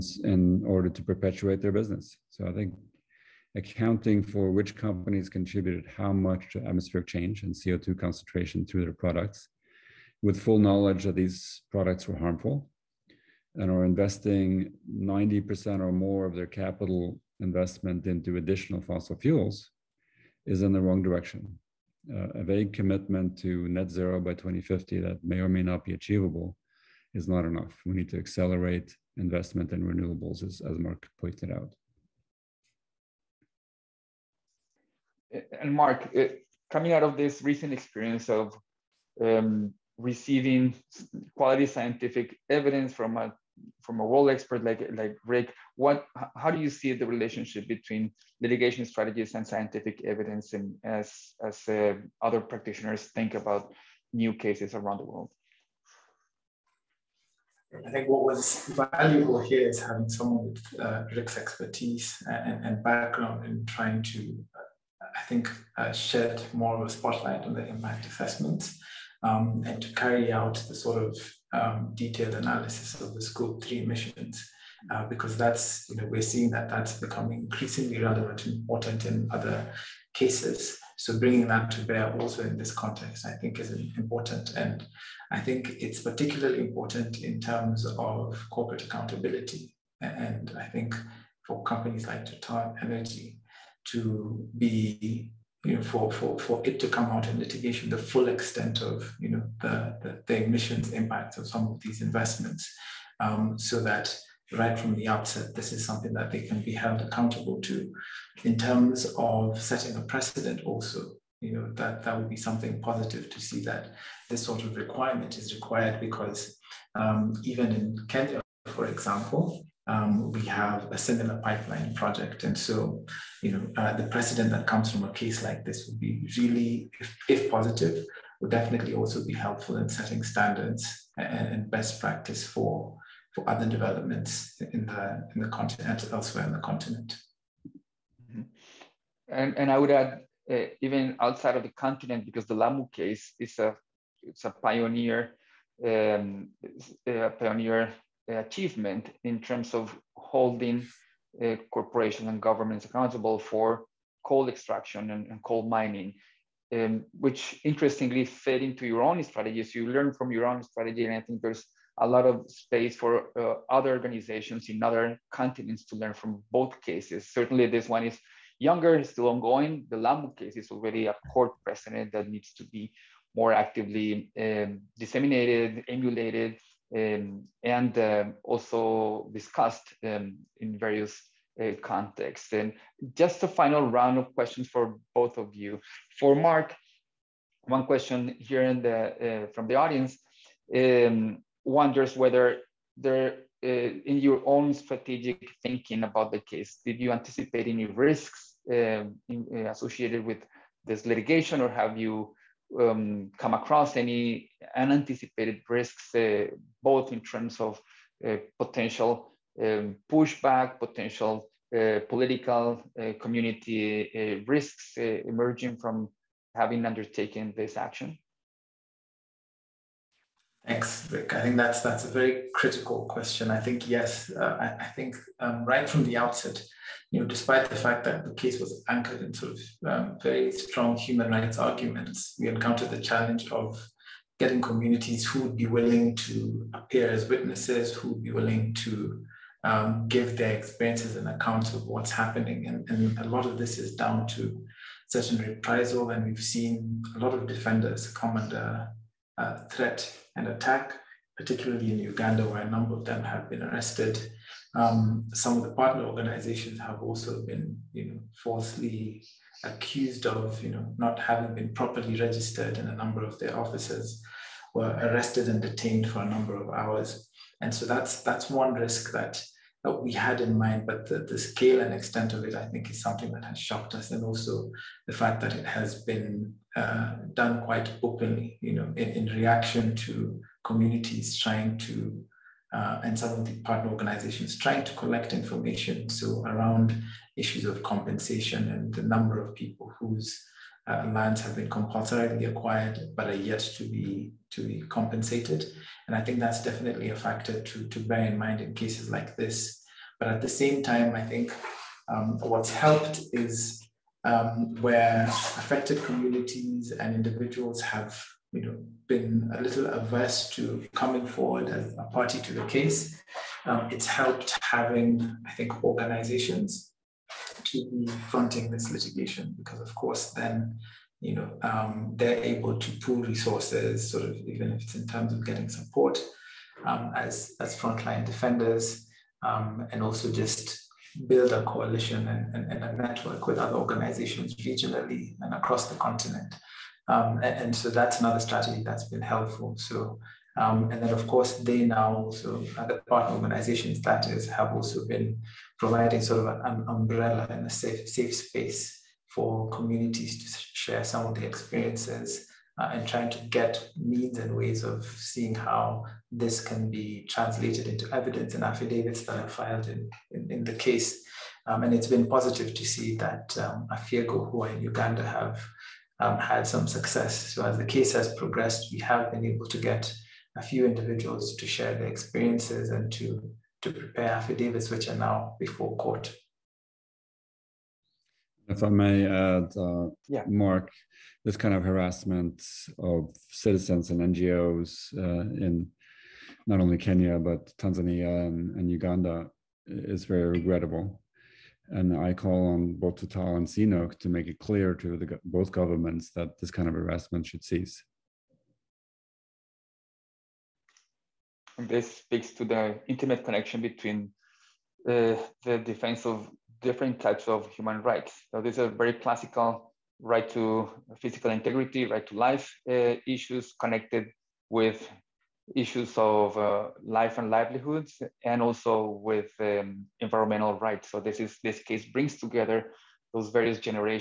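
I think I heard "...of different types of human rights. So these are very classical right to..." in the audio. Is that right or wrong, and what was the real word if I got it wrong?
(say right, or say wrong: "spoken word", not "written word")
right.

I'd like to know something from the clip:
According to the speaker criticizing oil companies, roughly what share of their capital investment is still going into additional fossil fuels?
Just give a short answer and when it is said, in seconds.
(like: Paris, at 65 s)
90% or more, at 14 s.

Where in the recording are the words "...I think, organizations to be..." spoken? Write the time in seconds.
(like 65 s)
315 s.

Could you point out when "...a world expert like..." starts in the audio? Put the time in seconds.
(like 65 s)
43 s.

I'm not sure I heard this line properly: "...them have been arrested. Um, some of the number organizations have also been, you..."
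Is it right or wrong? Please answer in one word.
wrong.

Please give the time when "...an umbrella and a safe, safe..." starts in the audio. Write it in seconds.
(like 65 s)
346 s.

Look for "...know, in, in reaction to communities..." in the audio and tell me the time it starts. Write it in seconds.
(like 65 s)
278 s.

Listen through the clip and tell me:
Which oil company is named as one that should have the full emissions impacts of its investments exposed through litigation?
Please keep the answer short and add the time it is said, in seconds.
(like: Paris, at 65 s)
Total Energy, at 92 s.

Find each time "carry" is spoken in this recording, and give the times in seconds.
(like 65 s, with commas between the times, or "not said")
69 s.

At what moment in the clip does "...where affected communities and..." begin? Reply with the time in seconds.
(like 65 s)
304 s.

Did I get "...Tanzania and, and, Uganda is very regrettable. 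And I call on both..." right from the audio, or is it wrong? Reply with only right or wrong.
right.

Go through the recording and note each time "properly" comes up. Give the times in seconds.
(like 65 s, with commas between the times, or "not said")
261 s.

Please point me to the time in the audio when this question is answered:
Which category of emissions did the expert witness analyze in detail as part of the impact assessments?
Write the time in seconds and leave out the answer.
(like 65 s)
73 s.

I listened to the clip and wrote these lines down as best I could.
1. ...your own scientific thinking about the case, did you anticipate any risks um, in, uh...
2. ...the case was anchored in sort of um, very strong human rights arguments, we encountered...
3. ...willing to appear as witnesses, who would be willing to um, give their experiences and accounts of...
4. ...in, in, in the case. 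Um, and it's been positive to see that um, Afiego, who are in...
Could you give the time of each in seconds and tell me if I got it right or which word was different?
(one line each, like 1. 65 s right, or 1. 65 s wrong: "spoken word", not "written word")
1. 194 s wrong: "strategic", not "scientific"
2. 228 s right
3. 235 s right
4. 359 s right.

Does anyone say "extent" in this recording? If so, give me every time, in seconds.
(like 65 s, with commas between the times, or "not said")
98 s, 271 s.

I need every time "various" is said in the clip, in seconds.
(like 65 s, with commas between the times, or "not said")
180 s, 423 s.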